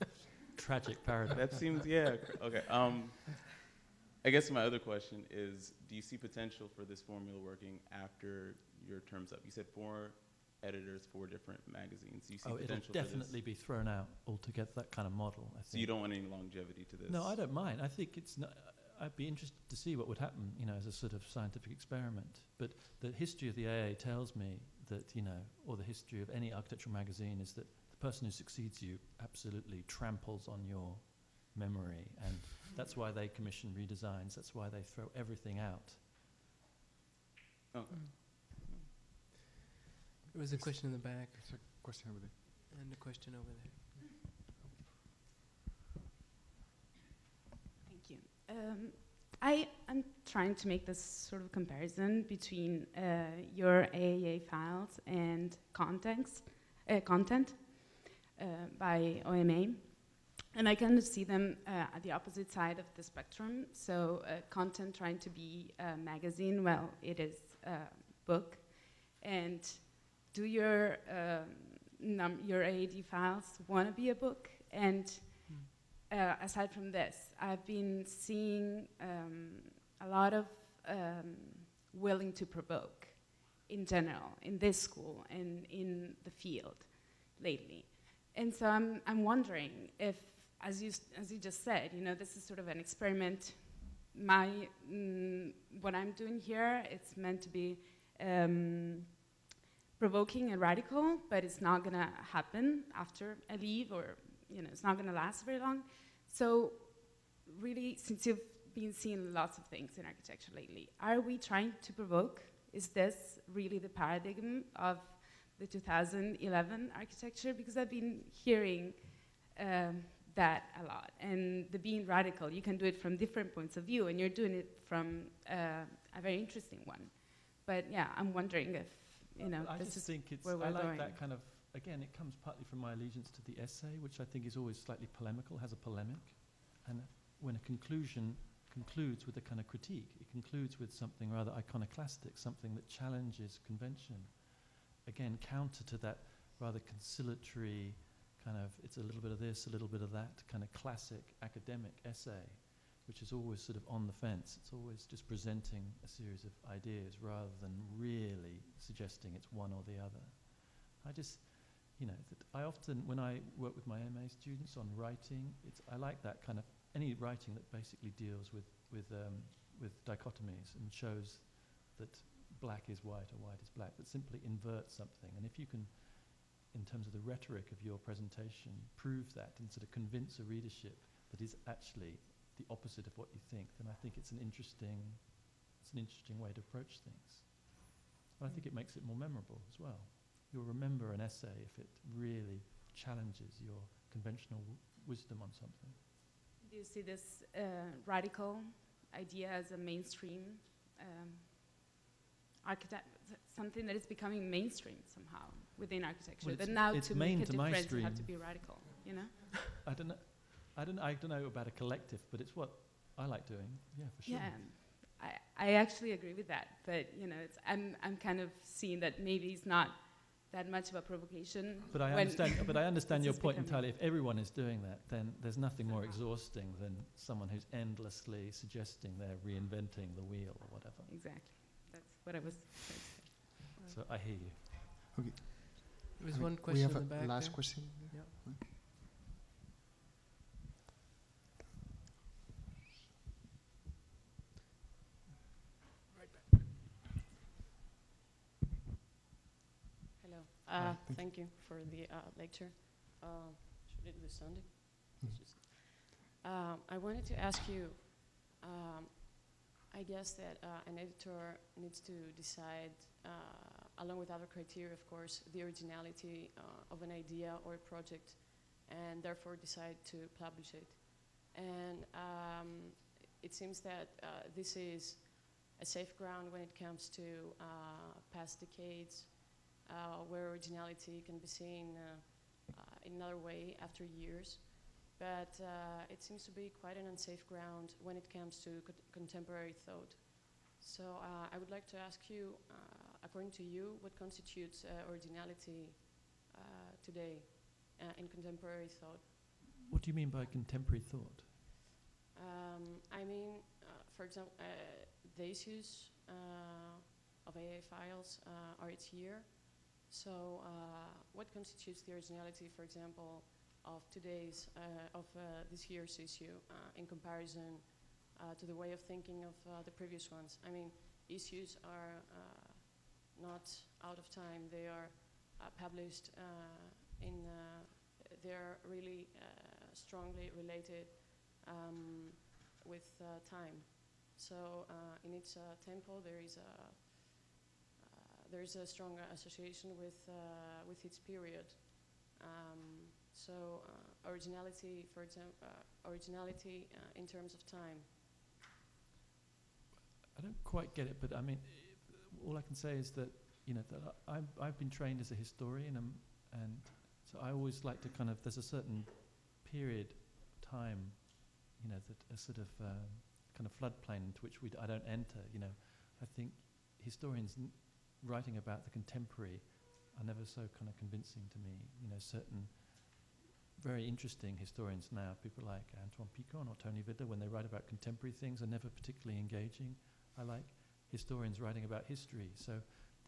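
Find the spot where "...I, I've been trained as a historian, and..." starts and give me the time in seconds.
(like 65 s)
354 s.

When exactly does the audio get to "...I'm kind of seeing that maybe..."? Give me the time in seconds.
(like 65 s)
218 s.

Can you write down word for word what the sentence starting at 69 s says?
And do your, um, your AA files want to be a book?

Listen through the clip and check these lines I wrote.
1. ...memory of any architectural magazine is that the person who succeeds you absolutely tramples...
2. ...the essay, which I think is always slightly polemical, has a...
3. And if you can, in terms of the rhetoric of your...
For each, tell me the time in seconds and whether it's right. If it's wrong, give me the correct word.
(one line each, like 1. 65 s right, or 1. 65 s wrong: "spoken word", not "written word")
1. 25 s wrong: "history", not "memory"
2. 133 s right
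3. 175 s right.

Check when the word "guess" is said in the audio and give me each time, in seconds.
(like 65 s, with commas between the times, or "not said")
4 s, 260 s.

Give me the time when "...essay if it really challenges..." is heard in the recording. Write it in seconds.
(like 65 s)
191 s.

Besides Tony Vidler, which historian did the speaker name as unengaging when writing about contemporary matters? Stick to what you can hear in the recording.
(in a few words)
Antoine Picon.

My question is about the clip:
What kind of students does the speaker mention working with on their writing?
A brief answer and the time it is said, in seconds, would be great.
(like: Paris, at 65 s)
MA students, at 164 s.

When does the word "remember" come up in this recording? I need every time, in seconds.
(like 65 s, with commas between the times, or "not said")
190 s.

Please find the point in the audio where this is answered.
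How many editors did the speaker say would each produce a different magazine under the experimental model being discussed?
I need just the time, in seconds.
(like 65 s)
9 s.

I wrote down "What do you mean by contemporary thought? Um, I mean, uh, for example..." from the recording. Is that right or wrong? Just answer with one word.
right.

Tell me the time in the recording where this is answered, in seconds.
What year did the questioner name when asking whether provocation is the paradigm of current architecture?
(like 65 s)
115 s.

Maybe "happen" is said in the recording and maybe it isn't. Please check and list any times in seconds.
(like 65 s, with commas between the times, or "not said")
20 s, 102 s.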